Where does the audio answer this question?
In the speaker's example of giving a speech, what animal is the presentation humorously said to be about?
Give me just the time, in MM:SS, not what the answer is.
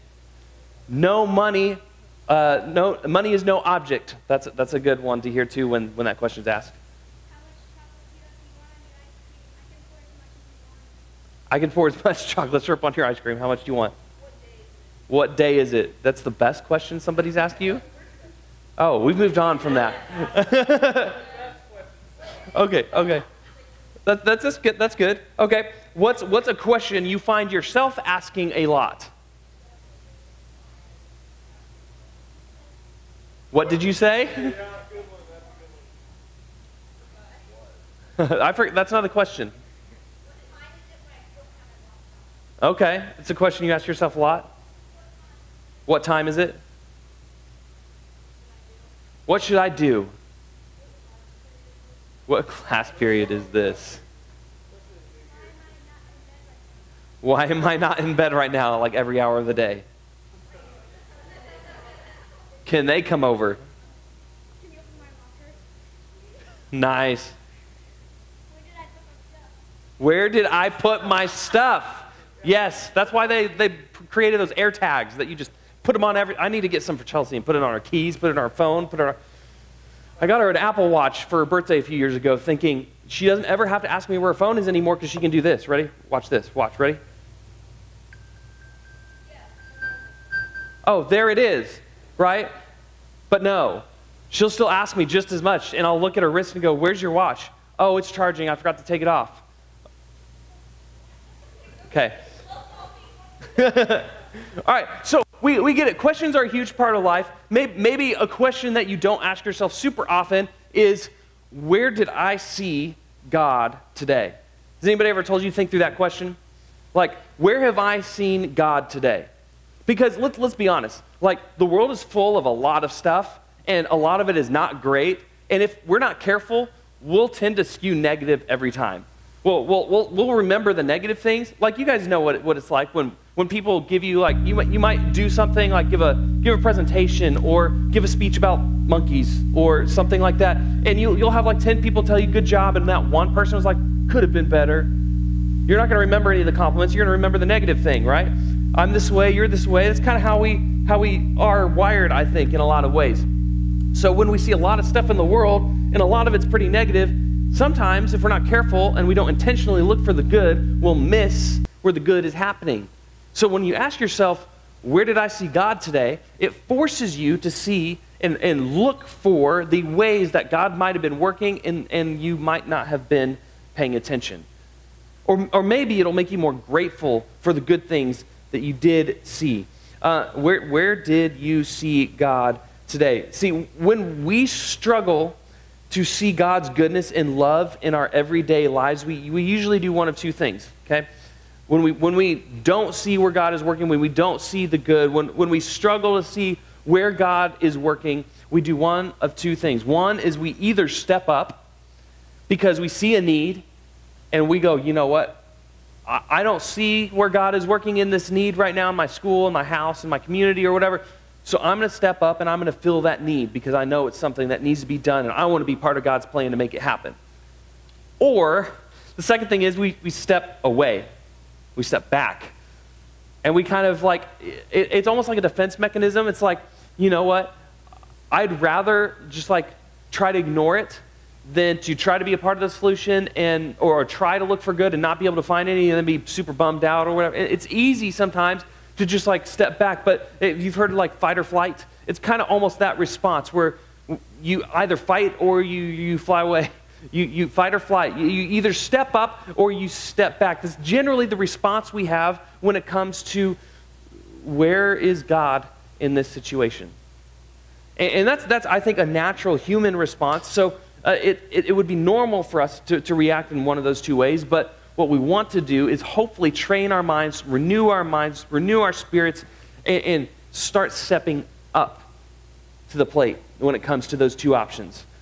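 02:18.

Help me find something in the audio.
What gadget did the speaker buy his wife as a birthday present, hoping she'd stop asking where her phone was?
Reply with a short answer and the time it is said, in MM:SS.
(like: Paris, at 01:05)
Apple Watch, at 01:20.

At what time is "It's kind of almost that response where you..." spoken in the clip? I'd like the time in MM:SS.
04:02.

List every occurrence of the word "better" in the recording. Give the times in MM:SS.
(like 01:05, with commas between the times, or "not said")
02:24.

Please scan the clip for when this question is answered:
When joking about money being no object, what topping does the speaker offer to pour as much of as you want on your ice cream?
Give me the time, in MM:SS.
00:12.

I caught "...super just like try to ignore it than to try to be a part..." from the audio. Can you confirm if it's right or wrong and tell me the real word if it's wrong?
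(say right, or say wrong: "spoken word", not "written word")
wrong: "rather", not "super".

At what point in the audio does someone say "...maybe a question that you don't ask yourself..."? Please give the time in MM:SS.
01:47.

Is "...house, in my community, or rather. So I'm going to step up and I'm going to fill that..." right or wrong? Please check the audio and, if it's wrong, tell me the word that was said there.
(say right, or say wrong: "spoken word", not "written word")
wrong: "whatever", not "rather".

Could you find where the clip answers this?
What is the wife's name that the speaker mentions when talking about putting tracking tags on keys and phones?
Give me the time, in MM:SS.
01:17.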